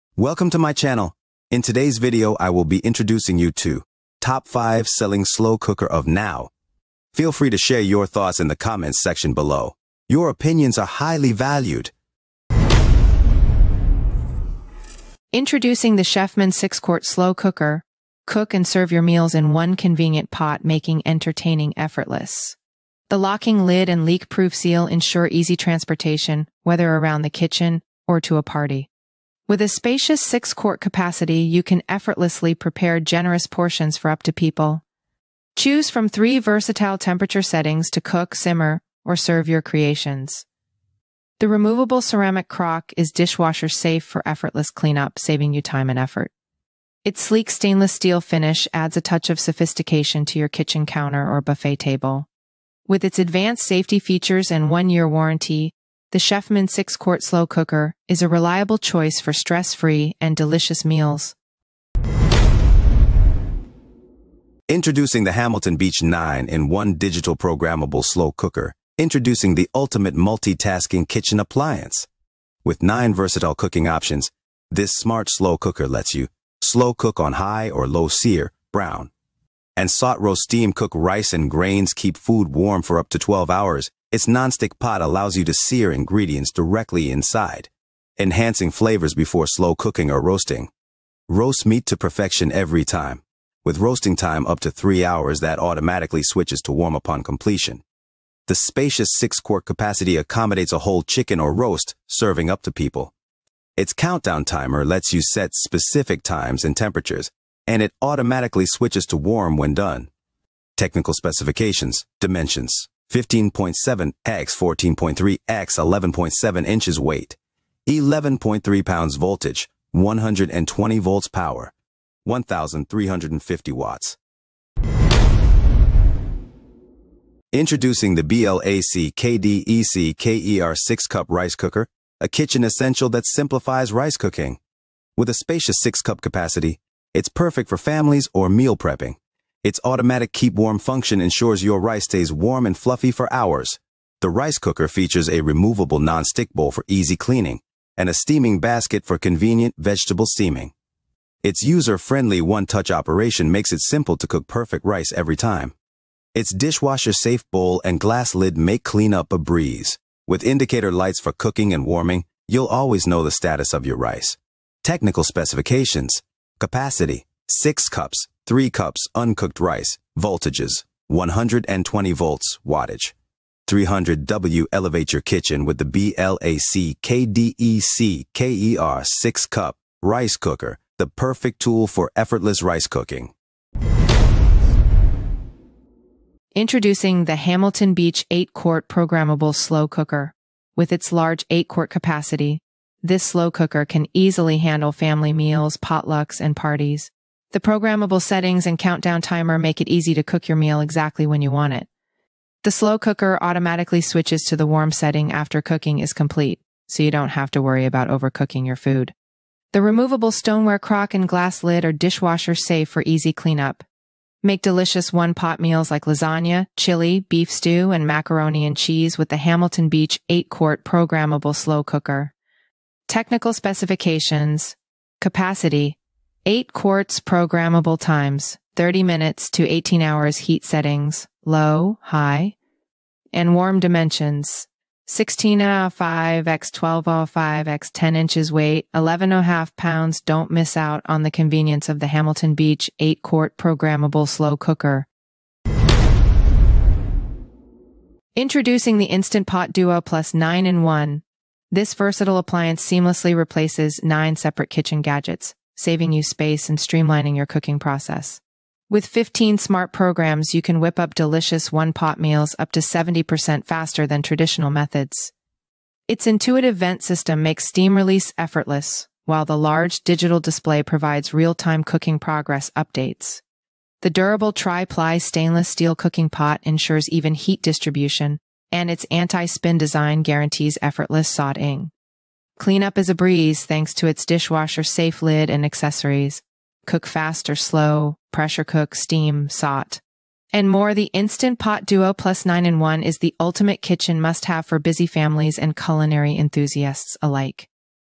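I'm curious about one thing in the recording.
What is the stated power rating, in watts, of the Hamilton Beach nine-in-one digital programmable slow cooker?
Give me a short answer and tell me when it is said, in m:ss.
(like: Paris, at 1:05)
1350 watts, at 2:02.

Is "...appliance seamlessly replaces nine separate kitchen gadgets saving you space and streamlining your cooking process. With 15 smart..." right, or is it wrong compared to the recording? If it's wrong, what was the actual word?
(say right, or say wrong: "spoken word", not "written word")
right.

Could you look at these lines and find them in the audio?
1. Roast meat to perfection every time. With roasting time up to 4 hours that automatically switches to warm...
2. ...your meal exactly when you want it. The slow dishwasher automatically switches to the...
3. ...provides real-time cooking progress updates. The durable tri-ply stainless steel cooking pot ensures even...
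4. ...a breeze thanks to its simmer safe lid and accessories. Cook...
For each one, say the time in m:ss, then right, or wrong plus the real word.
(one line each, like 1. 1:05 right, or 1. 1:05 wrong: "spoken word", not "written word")
1. 1:31 wrong: "3", not "4"
2. 3:20 wrong: "cooker", not "dishwasher"
3. 4:30 right
4. 4:43 wrong: "dishwasher", not "simmer".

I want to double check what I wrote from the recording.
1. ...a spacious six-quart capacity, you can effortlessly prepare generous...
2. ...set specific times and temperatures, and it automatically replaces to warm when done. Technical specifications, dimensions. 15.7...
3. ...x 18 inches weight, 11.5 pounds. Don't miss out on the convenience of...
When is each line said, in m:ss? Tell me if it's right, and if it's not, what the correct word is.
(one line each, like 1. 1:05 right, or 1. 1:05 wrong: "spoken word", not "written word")
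1. 0:29 right
2. 1:45 wrong: "switches", not "replaces"
3. 3:57 wrong: "10", not "18".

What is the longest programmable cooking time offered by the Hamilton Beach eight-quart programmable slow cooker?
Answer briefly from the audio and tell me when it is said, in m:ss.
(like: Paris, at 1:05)
18 hours, at 3:49.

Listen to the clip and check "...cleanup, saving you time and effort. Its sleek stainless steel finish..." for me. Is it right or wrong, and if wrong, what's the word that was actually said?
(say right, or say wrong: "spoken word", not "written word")
right.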